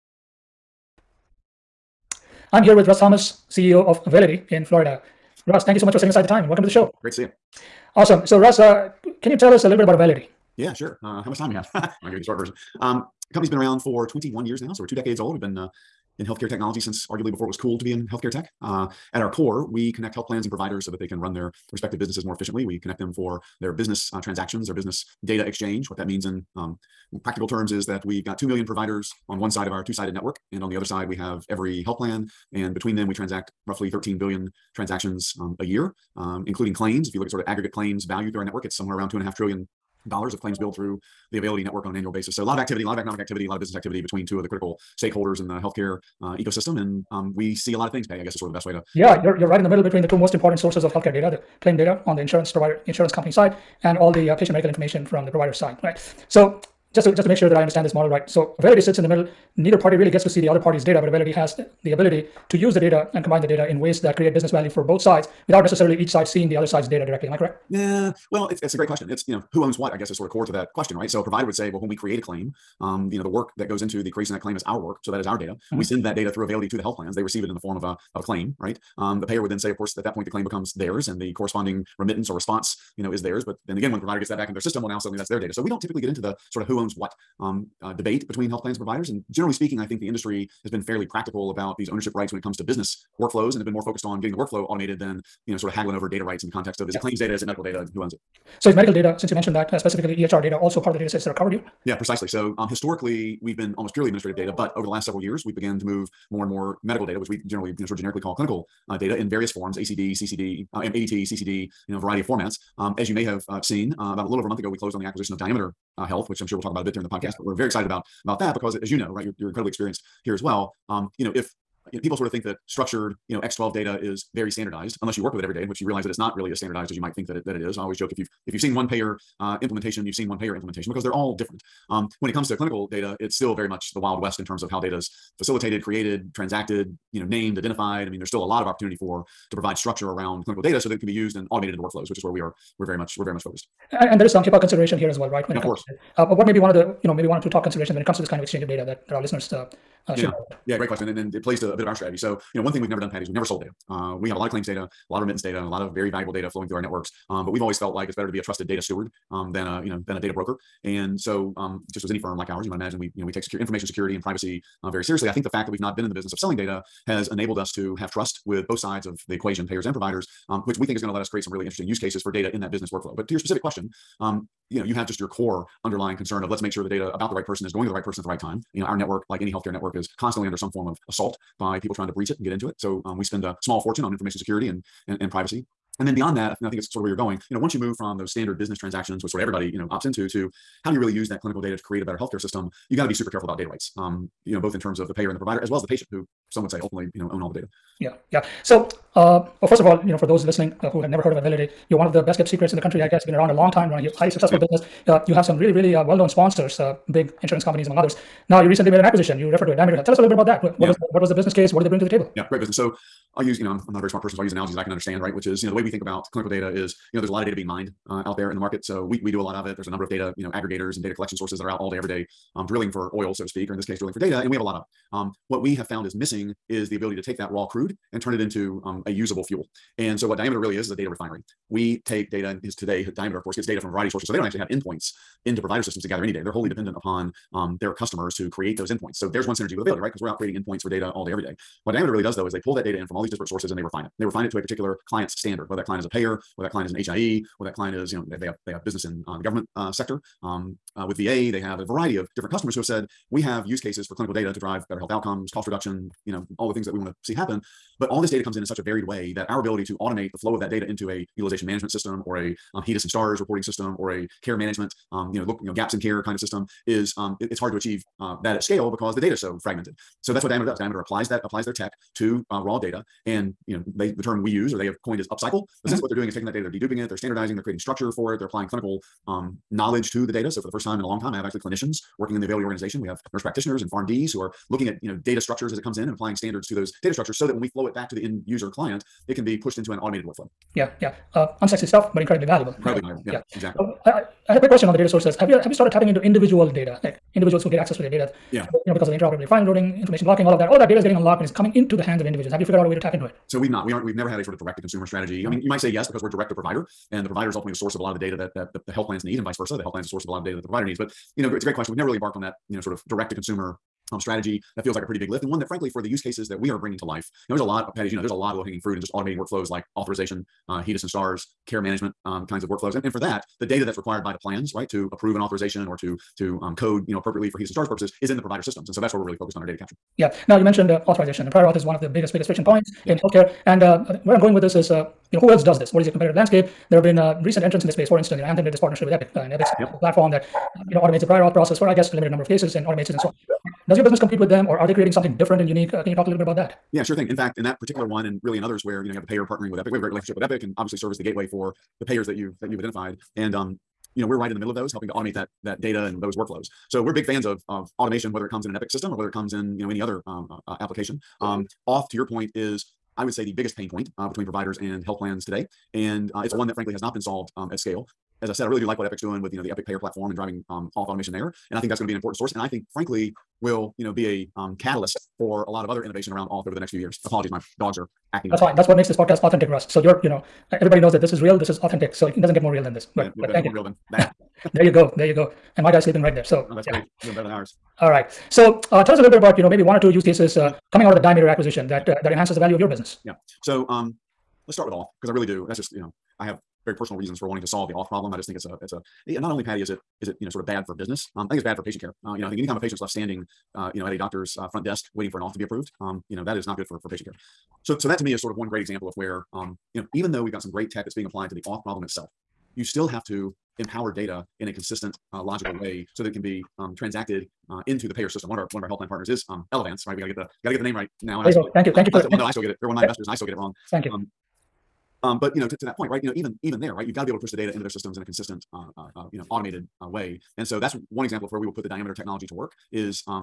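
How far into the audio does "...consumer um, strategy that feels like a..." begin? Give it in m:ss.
5:13.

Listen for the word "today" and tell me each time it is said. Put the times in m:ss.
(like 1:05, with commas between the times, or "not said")
3:52, 6:05.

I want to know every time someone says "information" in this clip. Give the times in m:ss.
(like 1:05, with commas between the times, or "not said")
0:54, 2:43, 3:04, 5:00.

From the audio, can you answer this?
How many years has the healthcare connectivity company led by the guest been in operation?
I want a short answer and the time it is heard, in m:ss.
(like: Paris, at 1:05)
21, at 0:14.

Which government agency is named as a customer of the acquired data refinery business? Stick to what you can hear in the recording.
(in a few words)
VA.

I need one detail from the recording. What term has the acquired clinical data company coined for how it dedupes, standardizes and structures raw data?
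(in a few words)
upcycle.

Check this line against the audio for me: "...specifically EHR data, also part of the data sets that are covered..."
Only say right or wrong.
right.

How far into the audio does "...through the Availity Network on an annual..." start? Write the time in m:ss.
0:40.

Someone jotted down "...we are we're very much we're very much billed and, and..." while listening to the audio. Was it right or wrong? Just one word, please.
wrong.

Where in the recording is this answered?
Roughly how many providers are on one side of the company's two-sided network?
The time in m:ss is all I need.
0:28.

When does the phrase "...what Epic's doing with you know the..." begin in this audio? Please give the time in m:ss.
6:08.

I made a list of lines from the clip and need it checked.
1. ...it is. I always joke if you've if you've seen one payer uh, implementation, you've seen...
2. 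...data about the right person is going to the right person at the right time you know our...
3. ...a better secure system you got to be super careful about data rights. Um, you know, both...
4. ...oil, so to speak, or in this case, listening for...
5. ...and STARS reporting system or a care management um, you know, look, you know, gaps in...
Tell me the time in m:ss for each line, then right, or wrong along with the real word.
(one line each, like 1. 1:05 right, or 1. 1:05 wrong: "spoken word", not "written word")
1. 2:07 right
2. 2:56 right
3. 3:12 wrong: "healthcare", not "secure"
4. 3:43 wrong: "drilling", not "listening"
5. 4:23 right.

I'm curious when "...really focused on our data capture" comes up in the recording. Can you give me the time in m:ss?
5:29.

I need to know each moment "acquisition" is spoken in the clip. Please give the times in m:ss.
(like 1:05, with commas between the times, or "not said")
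1:55, 3:29, 6:31.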